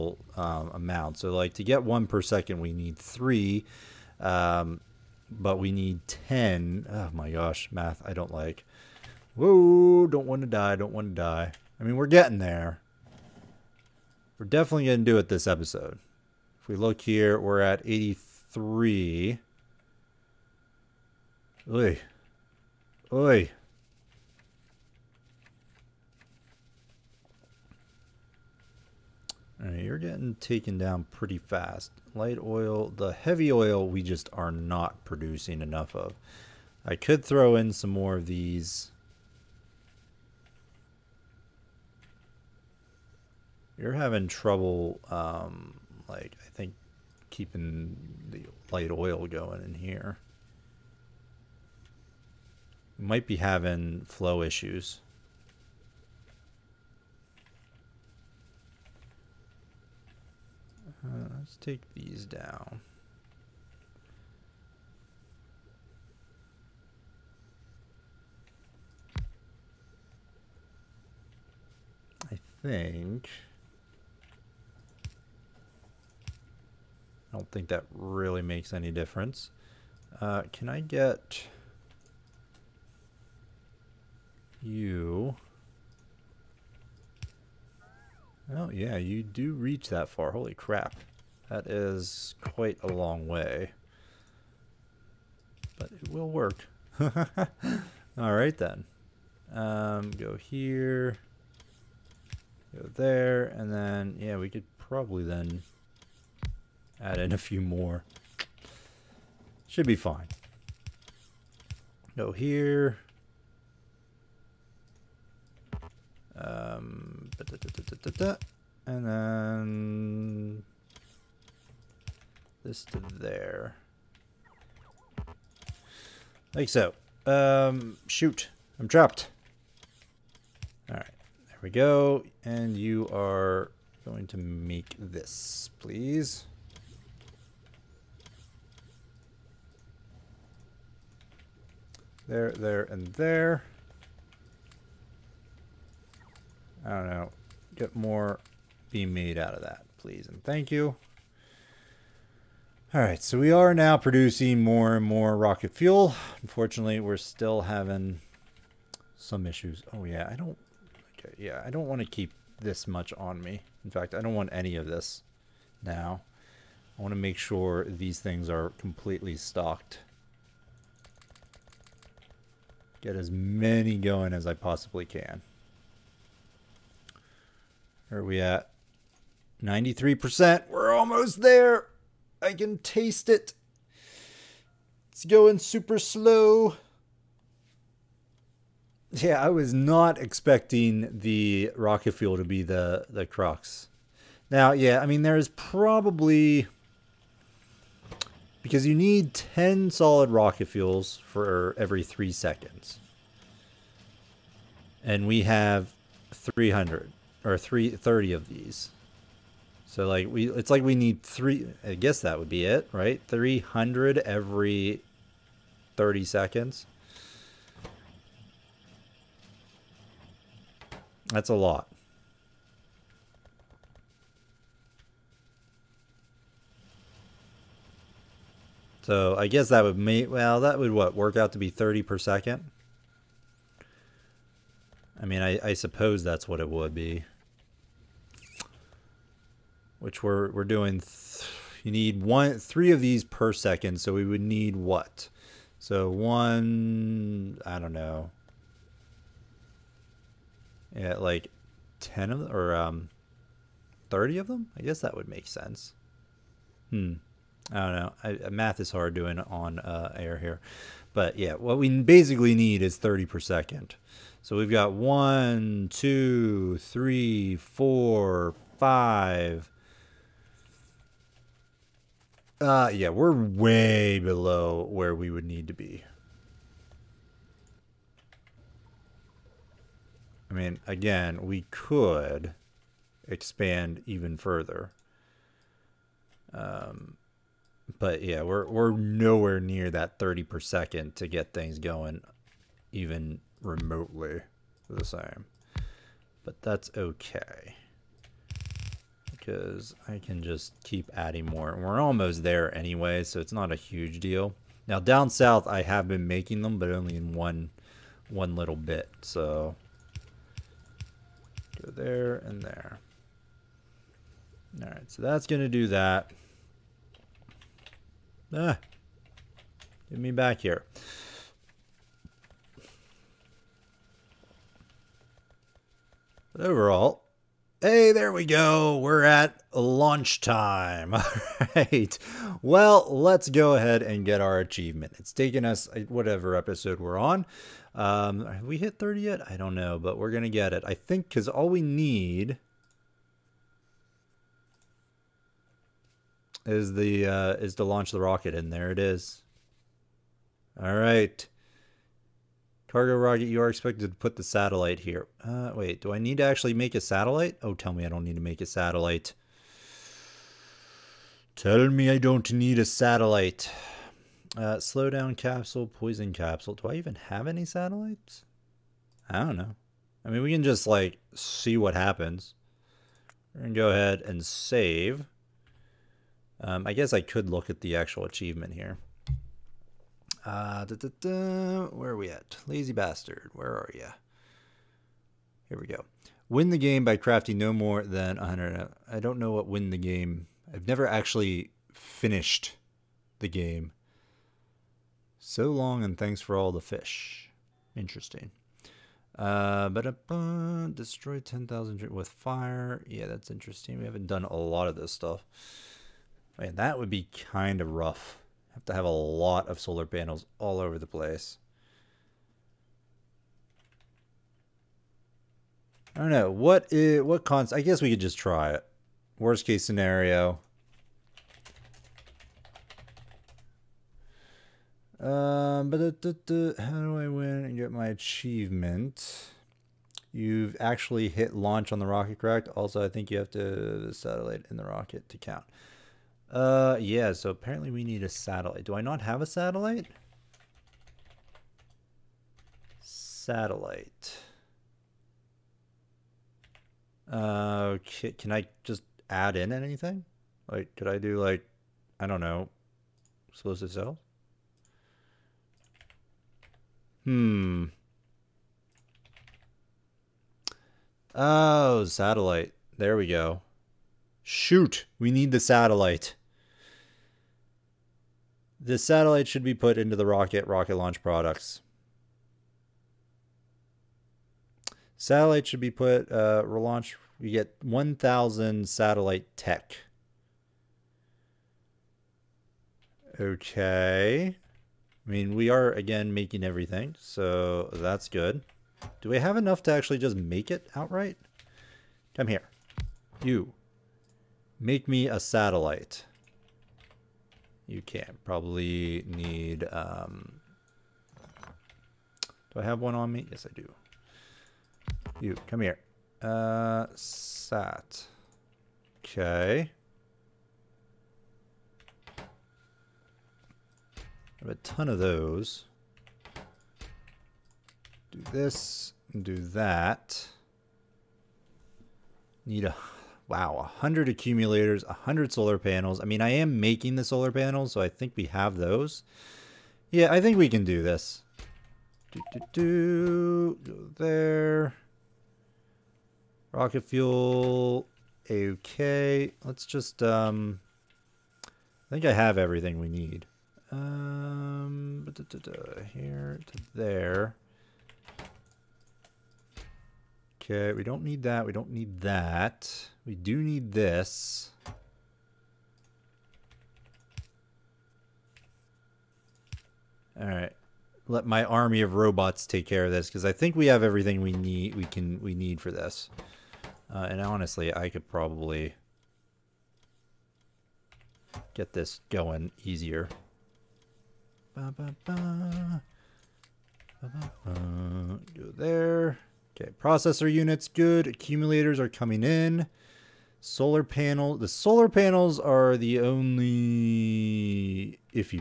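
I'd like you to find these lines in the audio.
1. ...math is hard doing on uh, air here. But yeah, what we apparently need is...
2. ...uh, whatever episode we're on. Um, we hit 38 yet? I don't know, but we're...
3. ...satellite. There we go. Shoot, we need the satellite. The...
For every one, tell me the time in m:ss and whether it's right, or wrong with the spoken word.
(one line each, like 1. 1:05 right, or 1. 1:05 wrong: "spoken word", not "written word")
1. 4:18 wrong: "basically", not "apparently"
2. 5:35 wrong: "30", not "38"
3. 7:42 right.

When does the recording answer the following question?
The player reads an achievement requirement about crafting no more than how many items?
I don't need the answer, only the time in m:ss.
6:27.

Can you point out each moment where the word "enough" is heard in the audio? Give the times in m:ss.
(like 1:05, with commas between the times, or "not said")
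0:35, 8:09.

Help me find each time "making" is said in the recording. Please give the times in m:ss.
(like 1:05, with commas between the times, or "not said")
5:06, 8:06, 8:46.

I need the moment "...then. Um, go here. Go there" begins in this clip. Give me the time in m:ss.
1:38.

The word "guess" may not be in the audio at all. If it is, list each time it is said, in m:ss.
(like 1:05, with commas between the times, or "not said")
3:31, 3:49, 4:14, 6:16, 6:57.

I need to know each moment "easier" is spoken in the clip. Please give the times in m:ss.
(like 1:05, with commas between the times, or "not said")
9:32.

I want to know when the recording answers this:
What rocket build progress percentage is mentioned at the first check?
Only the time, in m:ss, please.
0:17.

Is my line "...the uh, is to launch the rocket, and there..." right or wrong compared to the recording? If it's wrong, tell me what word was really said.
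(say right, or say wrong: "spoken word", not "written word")
right.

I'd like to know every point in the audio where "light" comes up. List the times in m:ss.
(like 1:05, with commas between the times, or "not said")
0:32, 0:48.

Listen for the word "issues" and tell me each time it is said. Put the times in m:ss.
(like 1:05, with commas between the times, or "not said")
0:54, 2:39.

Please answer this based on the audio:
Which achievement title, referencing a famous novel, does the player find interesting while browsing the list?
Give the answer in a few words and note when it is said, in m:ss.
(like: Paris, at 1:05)
So long and thanks for all the fish, at 6:35.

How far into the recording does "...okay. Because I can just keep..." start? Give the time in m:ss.
4:56.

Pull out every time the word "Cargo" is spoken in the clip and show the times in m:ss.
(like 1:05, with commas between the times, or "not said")
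5:52.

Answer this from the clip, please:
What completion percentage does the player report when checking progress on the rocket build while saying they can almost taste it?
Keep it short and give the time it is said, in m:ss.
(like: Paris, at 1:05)
93%, at 2:59.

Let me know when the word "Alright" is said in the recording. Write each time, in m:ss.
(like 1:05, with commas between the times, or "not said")
1:38, 2:10, 5:14.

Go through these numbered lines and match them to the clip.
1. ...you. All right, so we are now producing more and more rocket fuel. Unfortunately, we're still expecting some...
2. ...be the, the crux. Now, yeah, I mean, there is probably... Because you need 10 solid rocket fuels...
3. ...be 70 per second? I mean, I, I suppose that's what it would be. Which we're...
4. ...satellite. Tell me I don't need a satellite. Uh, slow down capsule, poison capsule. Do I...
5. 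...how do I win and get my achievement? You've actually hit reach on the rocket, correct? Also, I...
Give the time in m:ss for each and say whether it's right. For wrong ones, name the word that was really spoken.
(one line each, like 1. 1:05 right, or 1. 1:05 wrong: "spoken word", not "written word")
1. 2:30 wrong: "having", not "expecting"
2. 3:12 right
3. 3:51 wrong: "30", not "70"
4. 5:58 right
5. 7:06 wrong: "launch", not "reach".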